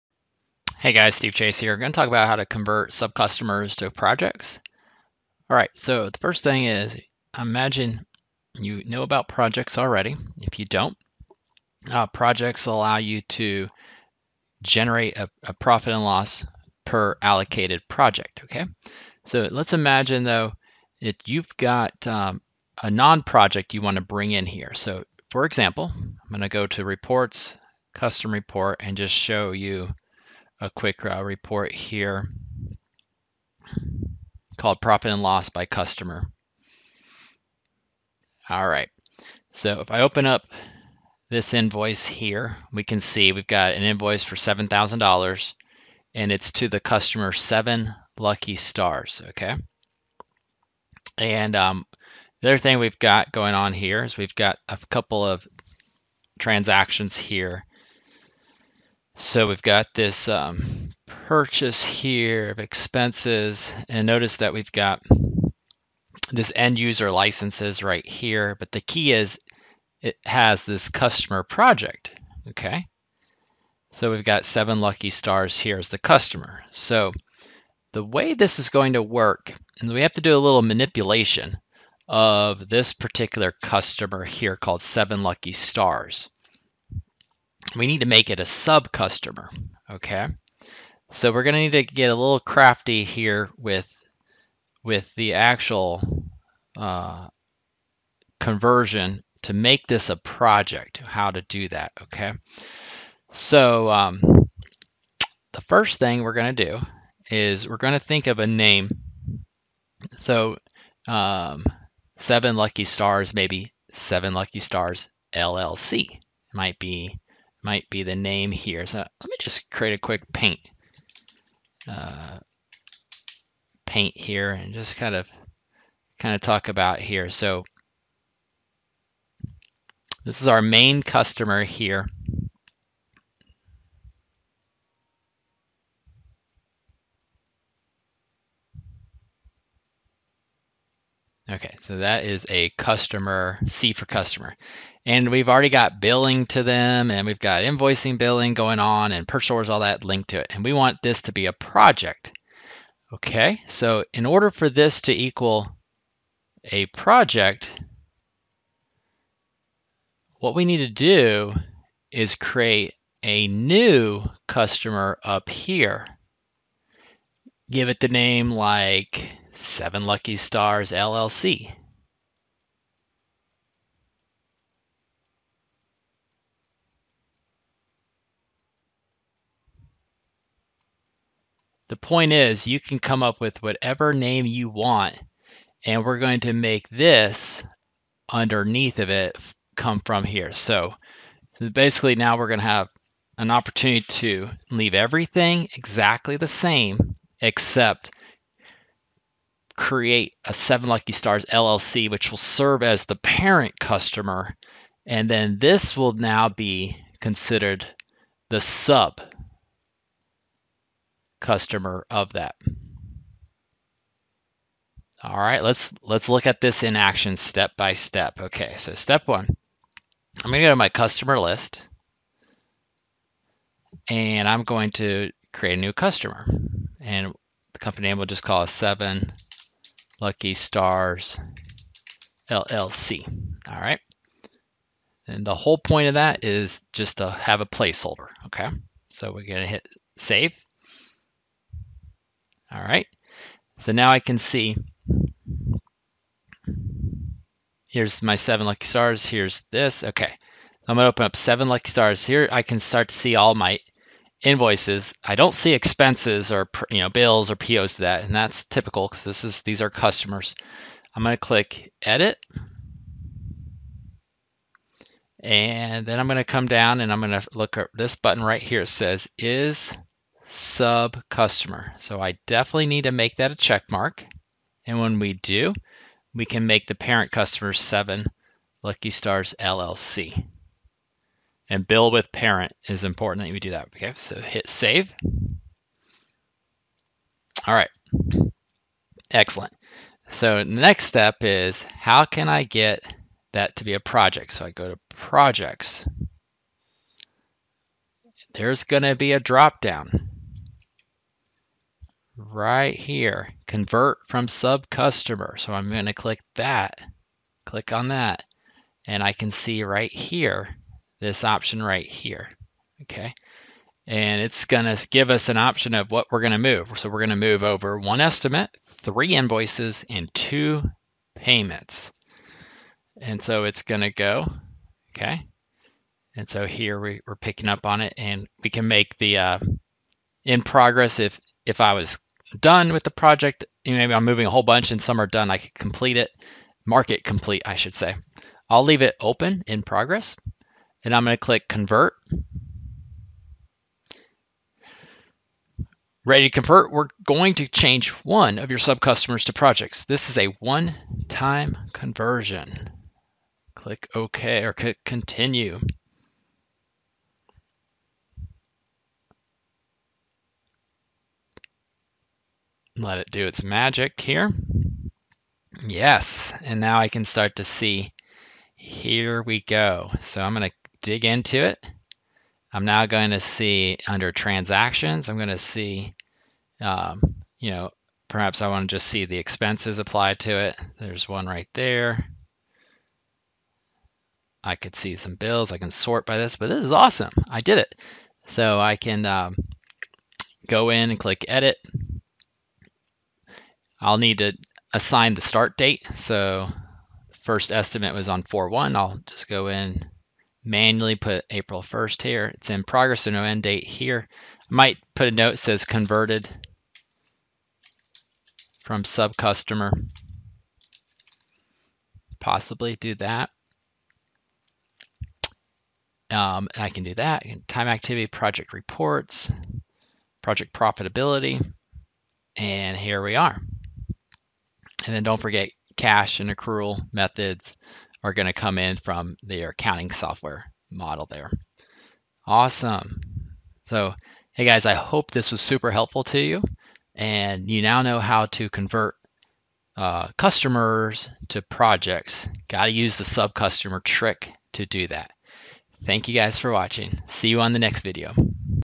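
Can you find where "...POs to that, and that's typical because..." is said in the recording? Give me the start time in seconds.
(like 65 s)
257 s.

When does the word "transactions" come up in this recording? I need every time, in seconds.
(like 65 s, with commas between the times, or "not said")
56 s, 374 s.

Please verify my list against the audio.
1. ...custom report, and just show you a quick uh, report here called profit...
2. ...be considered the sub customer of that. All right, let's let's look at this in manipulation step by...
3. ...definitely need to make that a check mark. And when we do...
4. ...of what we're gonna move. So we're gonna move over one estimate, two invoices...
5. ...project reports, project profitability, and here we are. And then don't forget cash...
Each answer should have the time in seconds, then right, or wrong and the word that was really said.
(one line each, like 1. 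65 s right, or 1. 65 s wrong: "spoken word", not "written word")
1. 27 s right
2. 206 s wrong: "action", not "manipulation"
3. 272 s right
4. 315 s wrong: "three", not "two"
5. 418 s right.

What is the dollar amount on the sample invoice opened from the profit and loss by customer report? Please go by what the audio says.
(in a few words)
$7,000.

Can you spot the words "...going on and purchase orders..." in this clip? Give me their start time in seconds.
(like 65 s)
148 s.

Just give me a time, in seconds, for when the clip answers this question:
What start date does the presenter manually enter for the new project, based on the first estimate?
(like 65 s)
401 s.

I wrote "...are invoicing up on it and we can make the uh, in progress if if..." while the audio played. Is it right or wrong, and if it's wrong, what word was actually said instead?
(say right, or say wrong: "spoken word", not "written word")
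wrong: "picking", not "invoicing".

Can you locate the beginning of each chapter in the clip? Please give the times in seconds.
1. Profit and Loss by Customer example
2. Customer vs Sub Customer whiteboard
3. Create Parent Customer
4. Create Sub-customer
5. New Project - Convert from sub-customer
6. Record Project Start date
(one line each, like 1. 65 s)
1. 33 s
2. 127 s
3. 223 s
4. 262 s
5. 293 s
6. 390 s.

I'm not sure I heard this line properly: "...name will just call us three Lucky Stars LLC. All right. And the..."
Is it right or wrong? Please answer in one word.
wrong.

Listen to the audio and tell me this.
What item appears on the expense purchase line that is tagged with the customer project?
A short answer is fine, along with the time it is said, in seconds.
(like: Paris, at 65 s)
End user licenses, at 66 s.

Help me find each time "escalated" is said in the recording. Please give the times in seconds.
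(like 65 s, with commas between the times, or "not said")
not said.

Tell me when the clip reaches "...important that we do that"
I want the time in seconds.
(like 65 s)
283 s.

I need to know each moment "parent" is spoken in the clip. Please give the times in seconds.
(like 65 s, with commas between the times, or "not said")
203 s, 276 s, 282 s.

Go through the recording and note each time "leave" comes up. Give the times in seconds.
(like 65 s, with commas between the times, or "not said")
194 s, 338 s.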